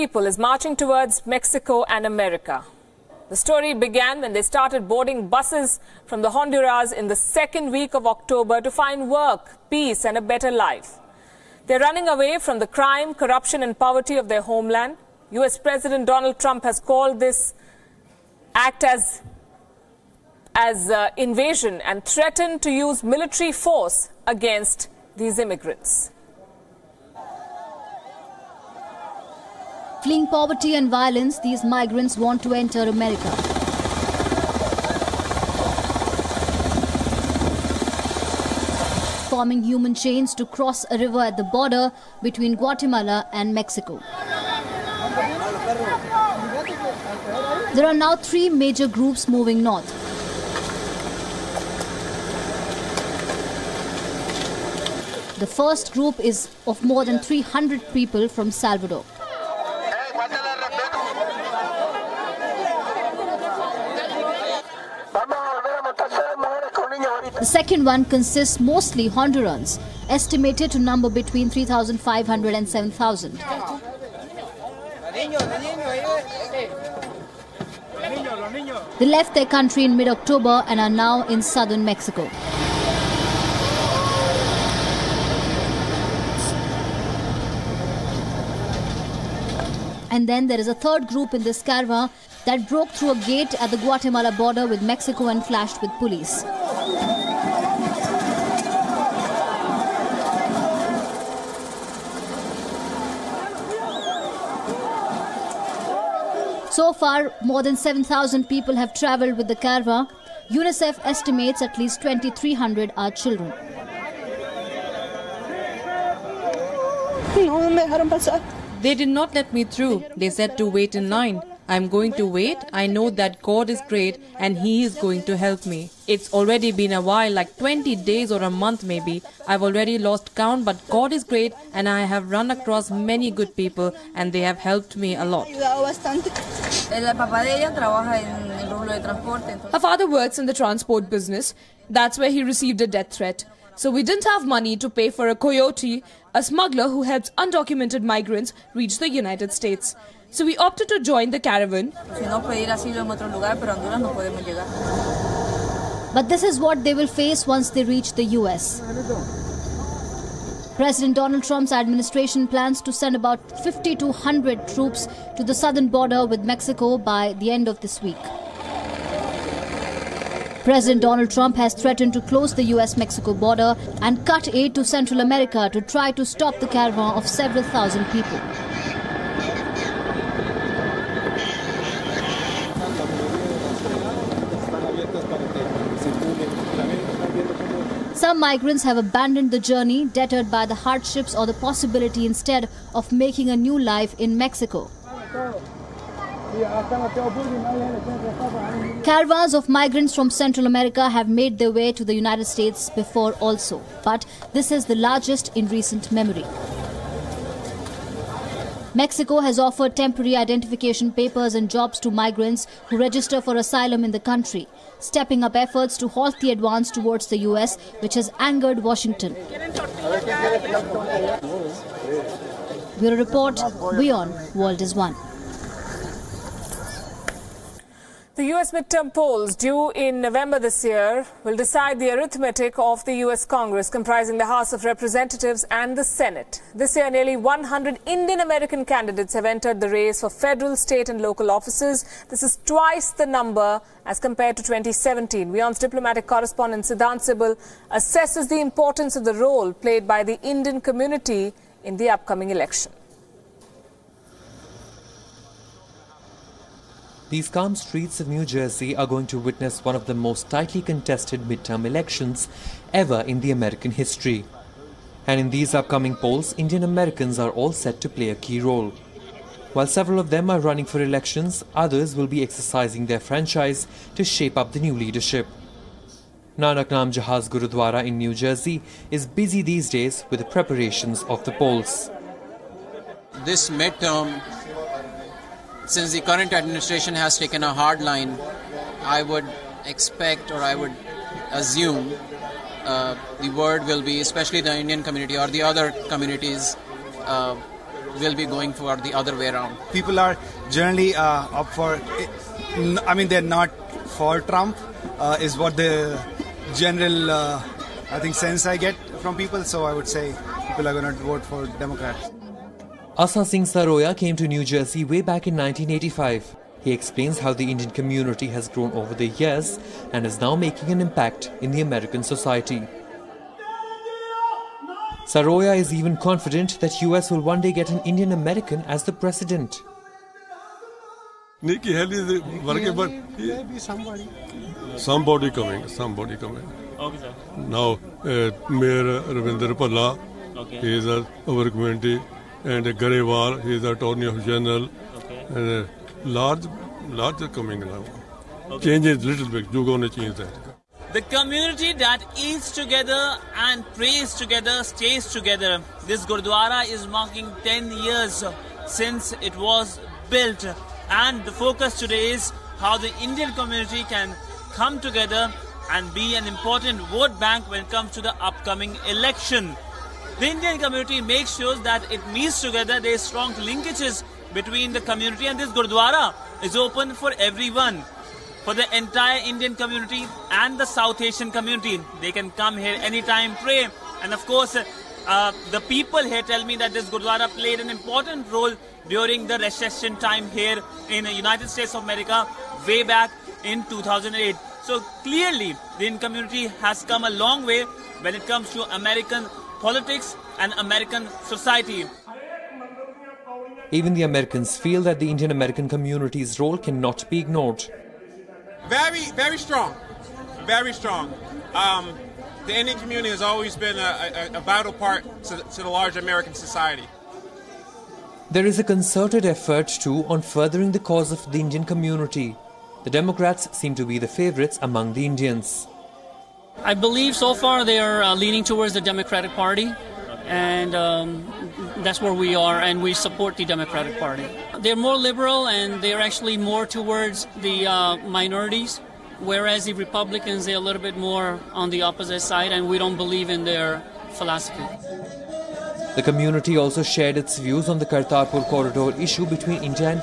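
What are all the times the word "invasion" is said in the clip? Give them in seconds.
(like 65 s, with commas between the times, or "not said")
21 s.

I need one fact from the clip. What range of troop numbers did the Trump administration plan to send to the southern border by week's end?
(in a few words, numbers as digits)
50 to 100.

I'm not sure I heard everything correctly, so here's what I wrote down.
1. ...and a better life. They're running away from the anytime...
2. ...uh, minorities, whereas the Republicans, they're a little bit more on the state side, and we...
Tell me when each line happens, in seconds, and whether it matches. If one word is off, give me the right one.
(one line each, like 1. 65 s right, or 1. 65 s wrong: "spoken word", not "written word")
1. 10 s wrong: "crime", not "anytime"
2. 437 s wrong: "opposite", not "state".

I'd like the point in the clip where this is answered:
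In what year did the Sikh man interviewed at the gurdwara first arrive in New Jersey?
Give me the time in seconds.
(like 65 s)
315 s.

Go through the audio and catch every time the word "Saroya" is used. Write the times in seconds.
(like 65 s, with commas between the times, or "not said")
313 s, 325 s.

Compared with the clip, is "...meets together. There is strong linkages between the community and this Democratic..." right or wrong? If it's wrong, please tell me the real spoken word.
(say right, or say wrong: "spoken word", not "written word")
wrong: "Gurdwara", not "Democratic".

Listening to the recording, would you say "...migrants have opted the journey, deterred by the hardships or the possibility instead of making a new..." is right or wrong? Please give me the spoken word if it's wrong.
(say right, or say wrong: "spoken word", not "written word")
wrong: "abandoned", not "opted".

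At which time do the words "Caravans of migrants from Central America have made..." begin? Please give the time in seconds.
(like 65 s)
199 s.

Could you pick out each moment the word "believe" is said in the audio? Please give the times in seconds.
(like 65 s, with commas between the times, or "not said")
426 s, 443 s.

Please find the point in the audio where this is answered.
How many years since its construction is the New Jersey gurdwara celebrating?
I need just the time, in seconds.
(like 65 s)
357 s.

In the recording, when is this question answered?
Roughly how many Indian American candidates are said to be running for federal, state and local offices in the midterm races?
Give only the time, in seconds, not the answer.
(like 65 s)
237 s.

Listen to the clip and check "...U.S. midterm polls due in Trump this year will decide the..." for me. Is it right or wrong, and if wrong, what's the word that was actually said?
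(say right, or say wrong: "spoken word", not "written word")
wrong: "November", not "Trump".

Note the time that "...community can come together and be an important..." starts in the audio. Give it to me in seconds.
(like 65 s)
363 s.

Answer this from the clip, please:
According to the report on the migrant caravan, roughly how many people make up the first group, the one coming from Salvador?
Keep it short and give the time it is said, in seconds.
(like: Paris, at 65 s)
300, at 57 s.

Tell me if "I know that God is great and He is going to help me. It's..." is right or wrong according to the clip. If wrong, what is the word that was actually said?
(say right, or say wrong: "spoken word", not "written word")
right.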